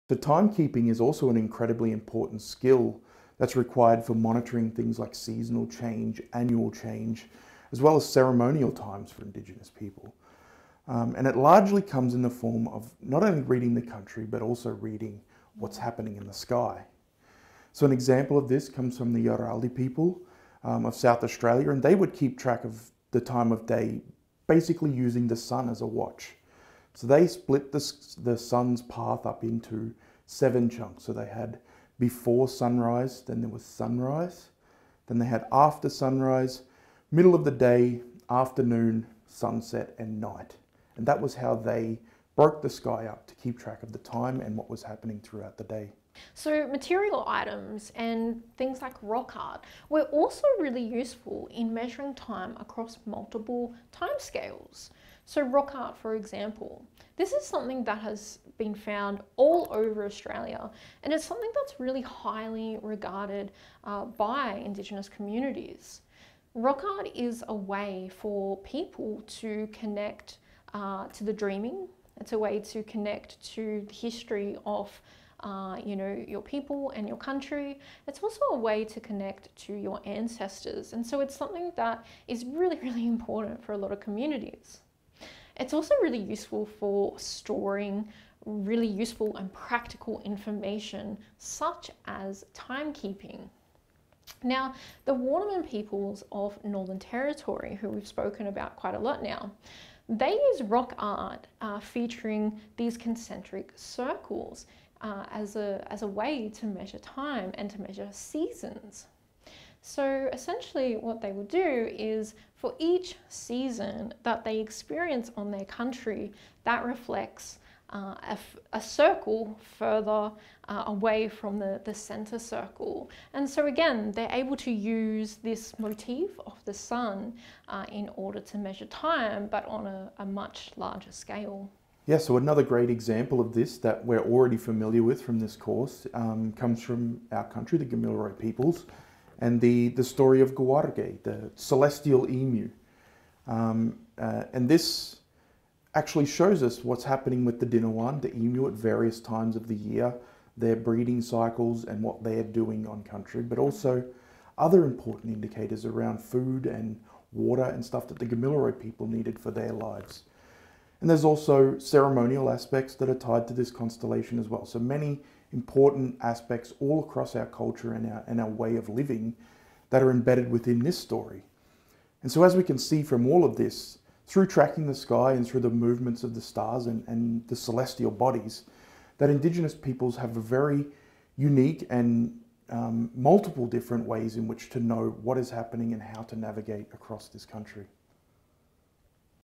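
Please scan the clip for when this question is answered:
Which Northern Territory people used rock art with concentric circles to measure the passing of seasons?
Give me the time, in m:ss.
1:35.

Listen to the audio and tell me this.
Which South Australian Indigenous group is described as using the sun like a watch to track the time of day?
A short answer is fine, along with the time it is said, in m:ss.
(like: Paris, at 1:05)
Yarraldi, at 0:19.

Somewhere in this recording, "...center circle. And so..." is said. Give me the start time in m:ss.
2:01.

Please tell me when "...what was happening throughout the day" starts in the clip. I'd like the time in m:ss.
0:44.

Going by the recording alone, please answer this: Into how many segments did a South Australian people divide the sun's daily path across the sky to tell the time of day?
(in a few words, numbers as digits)
7.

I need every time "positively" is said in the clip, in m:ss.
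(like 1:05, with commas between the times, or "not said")
not said.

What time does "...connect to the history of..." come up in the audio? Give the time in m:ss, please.
1:12.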